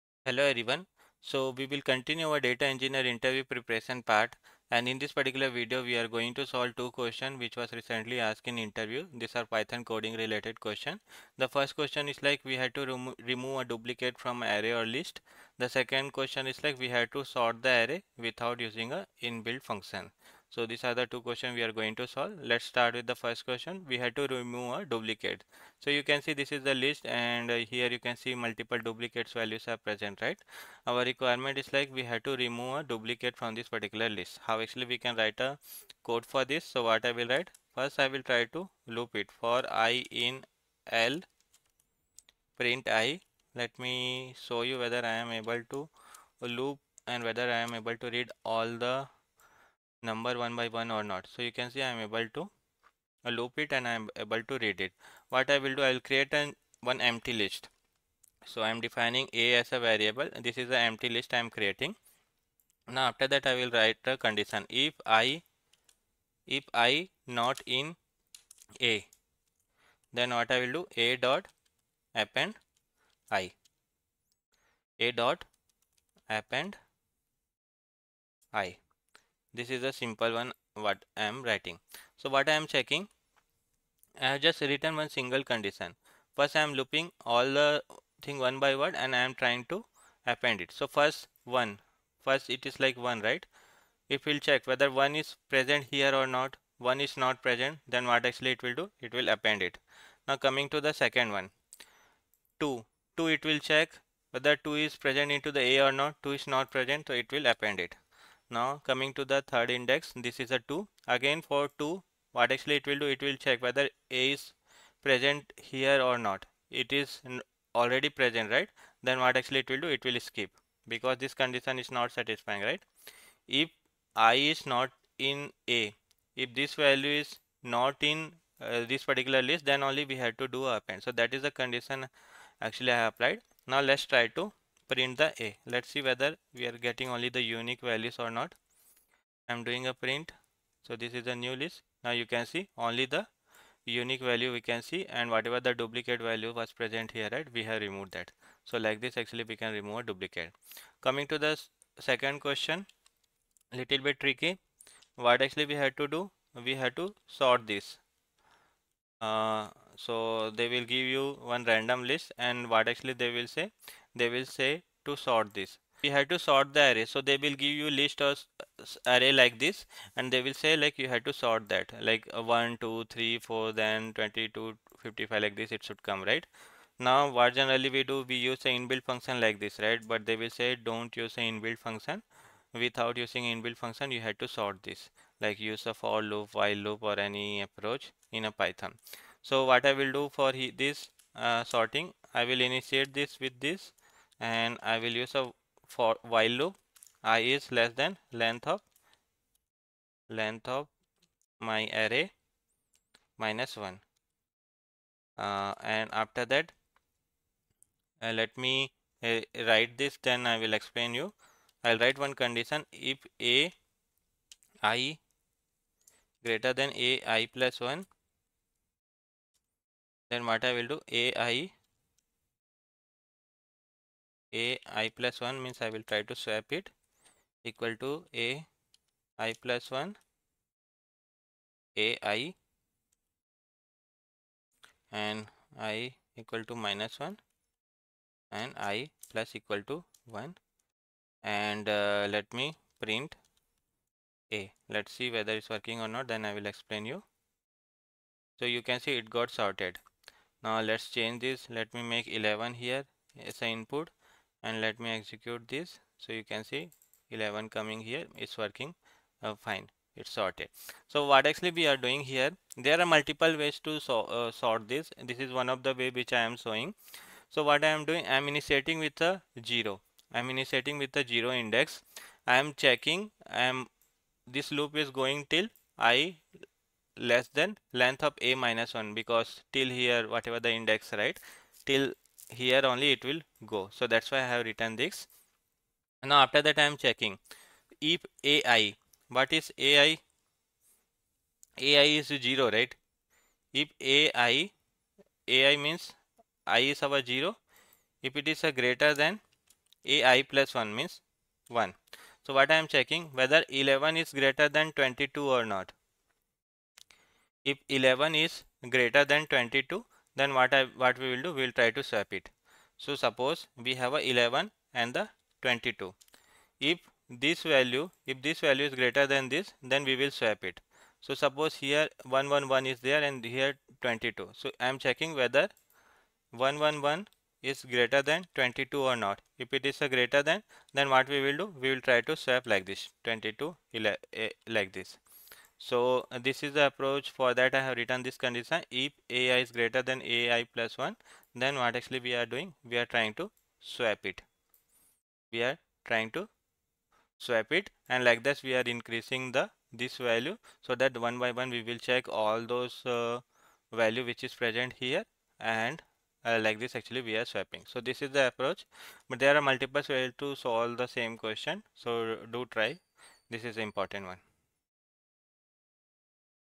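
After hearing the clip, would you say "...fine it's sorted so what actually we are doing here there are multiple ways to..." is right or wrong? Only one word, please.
right.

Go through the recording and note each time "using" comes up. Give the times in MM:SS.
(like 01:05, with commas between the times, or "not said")
00:18, 03:03.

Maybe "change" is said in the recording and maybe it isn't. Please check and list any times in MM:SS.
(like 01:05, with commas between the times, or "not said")
04:11.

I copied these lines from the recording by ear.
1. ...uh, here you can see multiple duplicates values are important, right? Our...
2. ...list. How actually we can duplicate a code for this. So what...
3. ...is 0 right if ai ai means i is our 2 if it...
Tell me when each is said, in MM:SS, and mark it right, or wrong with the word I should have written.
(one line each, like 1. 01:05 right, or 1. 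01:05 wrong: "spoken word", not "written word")
1. 00:27 wrong: "present", not "important"
2. 00:34 wrong: "write", not "duplicate"
3. 04:52 wrong: "0", not "2".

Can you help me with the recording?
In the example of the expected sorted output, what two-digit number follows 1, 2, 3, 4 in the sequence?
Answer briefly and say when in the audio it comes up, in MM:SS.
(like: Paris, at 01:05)
22, at 02:53.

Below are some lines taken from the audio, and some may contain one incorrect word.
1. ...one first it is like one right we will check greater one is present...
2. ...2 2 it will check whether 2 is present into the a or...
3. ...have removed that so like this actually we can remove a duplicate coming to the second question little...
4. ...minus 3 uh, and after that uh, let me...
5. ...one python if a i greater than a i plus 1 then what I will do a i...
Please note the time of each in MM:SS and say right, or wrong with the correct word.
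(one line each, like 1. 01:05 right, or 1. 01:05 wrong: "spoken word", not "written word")
1. 01:31 wrong: "whether", not "greater"
2. 01:42 right
3. 02:27 right
4. 03:23 wrong: "1", not "3"
5. 03:32 wrong: "condition", not "python".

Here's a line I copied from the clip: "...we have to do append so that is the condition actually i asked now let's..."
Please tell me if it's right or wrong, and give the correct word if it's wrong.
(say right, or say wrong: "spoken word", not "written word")
wrong: "applied", not "asked".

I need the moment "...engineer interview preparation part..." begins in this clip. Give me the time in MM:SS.
00:02.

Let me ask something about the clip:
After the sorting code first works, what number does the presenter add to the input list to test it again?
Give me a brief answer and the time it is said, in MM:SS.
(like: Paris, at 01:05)
11, at 04:11.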